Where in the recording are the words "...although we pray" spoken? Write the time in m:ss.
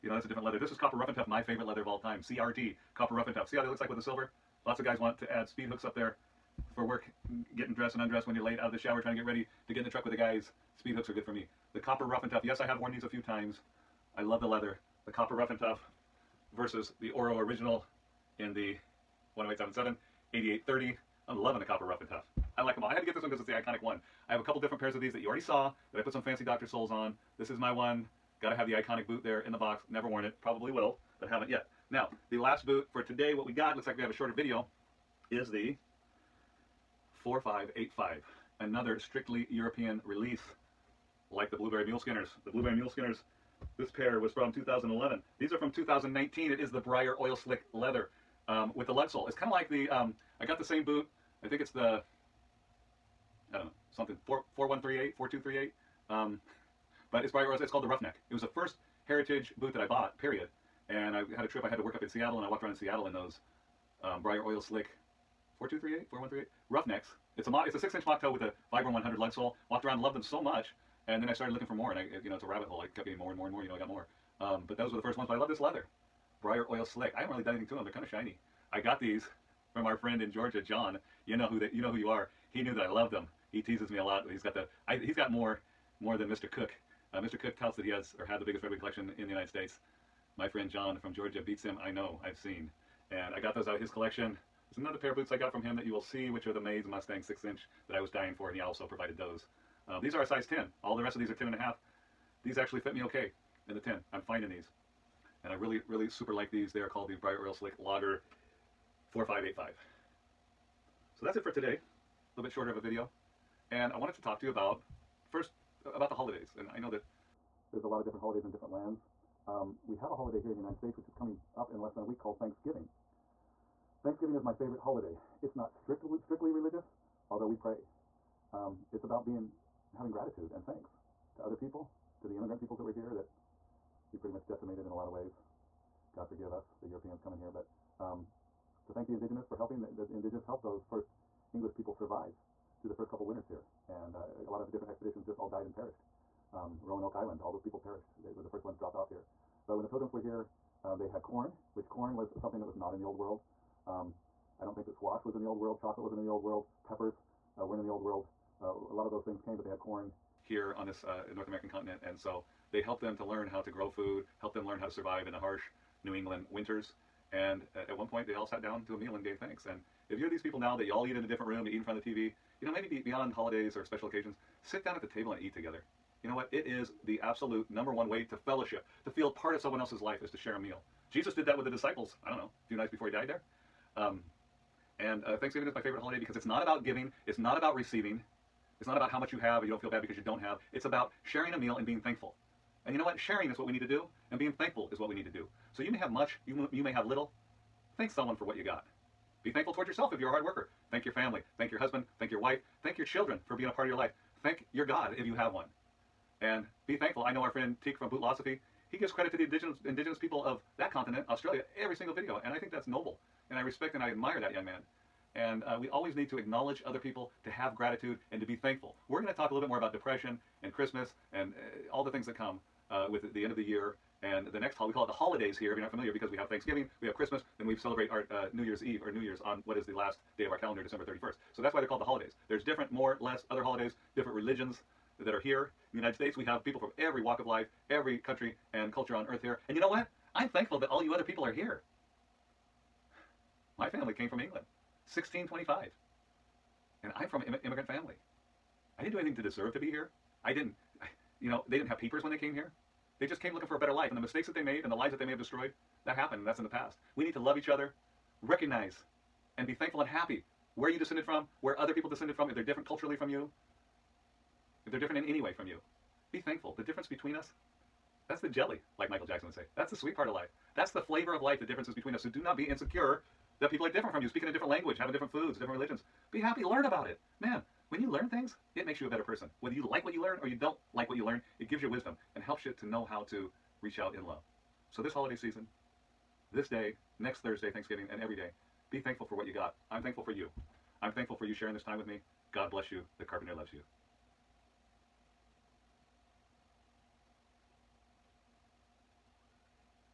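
2:07.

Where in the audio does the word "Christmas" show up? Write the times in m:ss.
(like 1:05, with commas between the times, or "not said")
3:40, 3:47.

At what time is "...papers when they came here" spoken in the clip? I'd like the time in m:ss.
4:11.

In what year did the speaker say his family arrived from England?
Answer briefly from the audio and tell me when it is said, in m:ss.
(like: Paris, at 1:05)
1625, at 4:05.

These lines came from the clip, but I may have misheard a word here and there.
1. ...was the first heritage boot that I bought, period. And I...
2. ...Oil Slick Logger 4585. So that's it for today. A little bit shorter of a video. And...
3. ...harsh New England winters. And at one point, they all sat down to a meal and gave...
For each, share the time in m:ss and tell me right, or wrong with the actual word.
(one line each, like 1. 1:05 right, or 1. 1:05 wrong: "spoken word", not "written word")
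1. 0:58 right
2. 1:47 right
3. 2:45 right.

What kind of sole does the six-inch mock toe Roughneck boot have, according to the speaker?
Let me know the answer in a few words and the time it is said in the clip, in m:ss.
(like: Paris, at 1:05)
Vibram 100 lug sole, at 1:08.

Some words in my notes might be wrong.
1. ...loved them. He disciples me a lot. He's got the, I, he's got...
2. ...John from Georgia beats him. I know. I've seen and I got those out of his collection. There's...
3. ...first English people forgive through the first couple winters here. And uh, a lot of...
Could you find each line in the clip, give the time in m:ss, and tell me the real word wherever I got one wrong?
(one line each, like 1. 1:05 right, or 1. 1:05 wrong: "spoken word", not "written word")
1. 1:22 wrong: "teases", not "disciples"
2. 1:30 right
3. 2:20 wrong: "survive", not "forgive".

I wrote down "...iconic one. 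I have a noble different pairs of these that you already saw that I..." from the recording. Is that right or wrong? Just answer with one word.
wrong.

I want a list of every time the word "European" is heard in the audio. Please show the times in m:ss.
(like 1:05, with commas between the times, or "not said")
0:39, 2:16.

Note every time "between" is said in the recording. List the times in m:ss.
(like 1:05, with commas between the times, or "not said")
4:27, 4:31.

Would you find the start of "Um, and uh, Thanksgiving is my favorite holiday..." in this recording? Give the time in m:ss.
3:03.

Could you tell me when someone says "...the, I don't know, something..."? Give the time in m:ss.
0:51.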